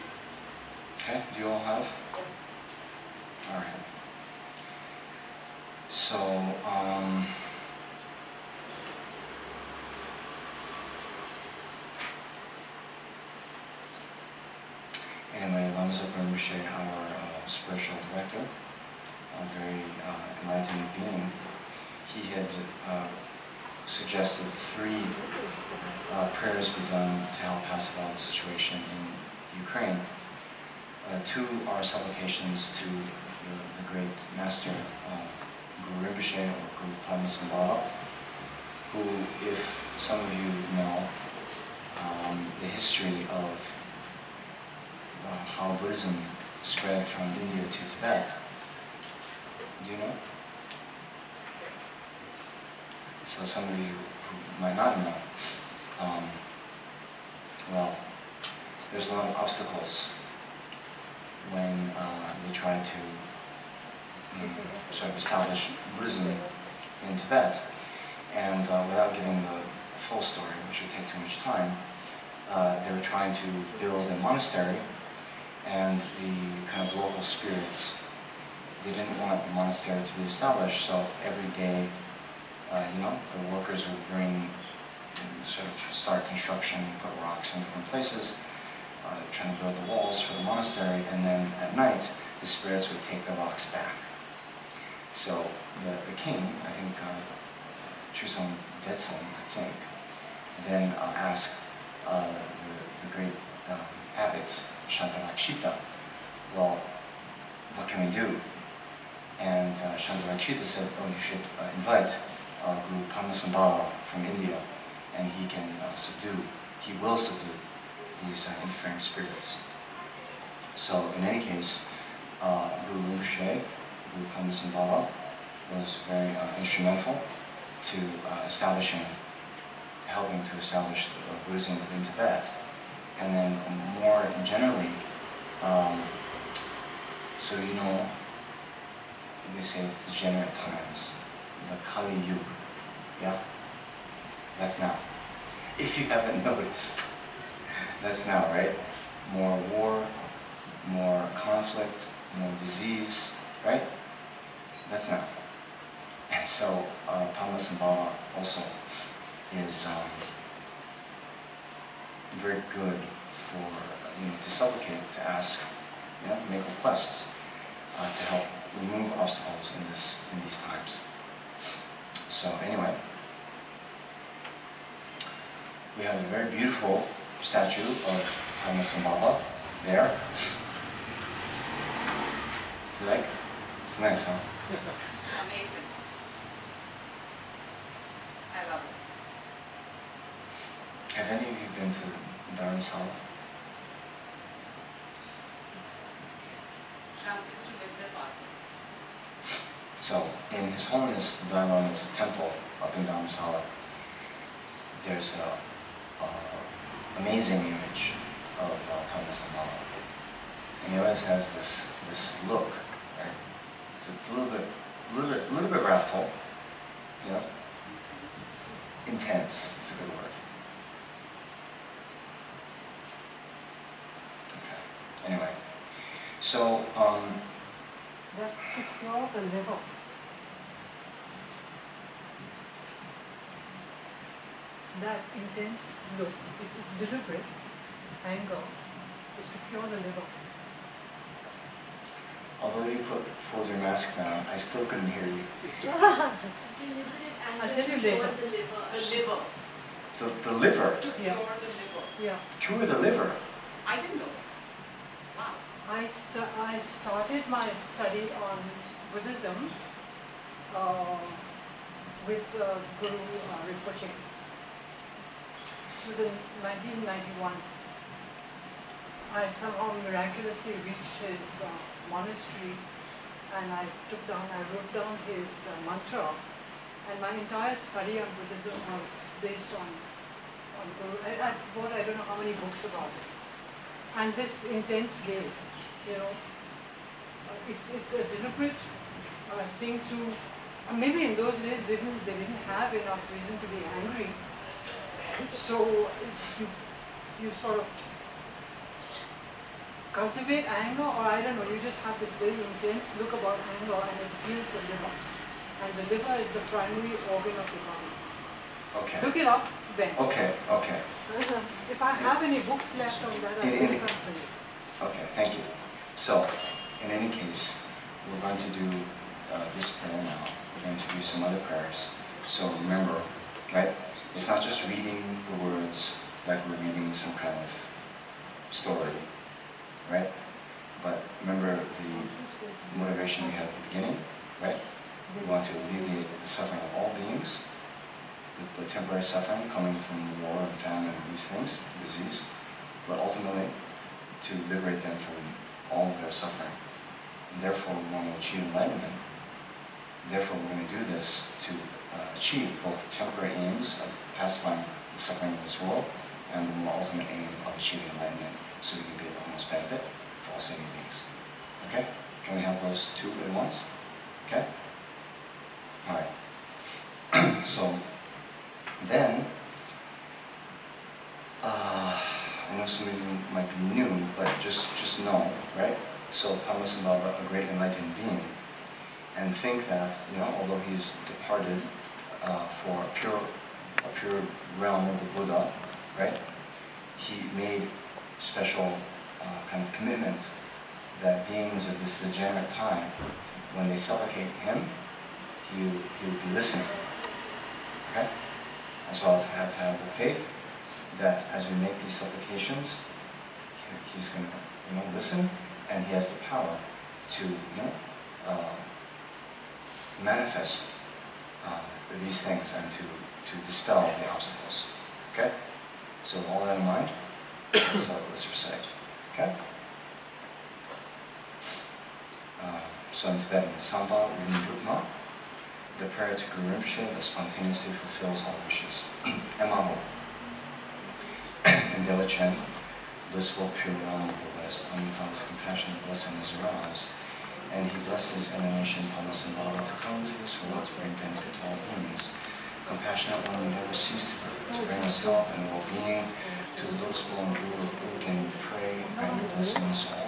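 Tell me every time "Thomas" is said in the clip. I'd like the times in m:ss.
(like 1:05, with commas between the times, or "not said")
3:29, 6:16.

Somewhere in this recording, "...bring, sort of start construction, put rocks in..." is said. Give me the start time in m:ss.
1:24.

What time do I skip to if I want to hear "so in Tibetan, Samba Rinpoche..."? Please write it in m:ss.
7:03.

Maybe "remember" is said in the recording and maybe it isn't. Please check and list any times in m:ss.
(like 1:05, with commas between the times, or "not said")
5:22, 5:31.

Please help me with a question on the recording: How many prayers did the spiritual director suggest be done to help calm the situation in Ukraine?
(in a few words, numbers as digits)
3.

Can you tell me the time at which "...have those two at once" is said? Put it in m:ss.
6:02.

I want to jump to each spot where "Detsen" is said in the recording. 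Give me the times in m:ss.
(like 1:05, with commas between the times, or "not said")
1:38.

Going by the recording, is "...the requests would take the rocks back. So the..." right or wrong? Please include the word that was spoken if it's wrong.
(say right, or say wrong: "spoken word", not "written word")
wrong: "spirits", not "requests".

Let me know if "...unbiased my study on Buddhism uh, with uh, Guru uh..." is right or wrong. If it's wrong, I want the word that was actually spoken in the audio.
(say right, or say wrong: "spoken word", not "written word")
wrong: "started", not "unbiased".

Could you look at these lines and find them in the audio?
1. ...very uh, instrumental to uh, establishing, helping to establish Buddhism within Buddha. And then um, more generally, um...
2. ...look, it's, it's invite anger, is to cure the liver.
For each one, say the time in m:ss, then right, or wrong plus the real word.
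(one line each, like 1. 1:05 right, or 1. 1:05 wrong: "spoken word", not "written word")
1. 2:06 wrong: "Tibet", not "Buddha"
2. 3:56 wrong: "deliberate", not "invite".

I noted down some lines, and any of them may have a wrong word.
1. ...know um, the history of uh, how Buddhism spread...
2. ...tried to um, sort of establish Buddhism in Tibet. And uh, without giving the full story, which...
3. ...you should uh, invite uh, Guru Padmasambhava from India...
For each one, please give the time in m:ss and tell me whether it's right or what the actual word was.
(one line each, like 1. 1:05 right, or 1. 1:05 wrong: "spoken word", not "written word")
1. 0:40 right
2. 1:02 right
3. 1:51 right.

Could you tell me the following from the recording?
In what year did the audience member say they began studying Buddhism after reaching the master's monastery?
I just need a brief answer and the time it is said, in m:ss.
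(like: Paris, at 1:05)
1991, at 4:26.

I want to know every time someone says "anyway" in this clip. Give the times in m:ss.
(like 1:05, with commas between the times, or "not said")
0:15, 2:52, 3:45.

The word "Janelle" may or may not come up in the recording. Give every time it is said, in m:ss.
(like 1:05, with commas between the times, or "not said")
not said.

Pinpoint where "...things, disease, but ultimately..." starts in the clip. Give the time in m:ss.
5:41.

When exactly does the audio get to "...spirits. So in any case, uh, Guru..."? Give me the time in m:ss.
1:58.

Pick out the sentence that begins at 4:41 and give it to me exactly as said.
I, I bought I don't know how many books about it.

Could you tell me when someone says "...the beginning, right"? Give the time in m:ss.
5:33.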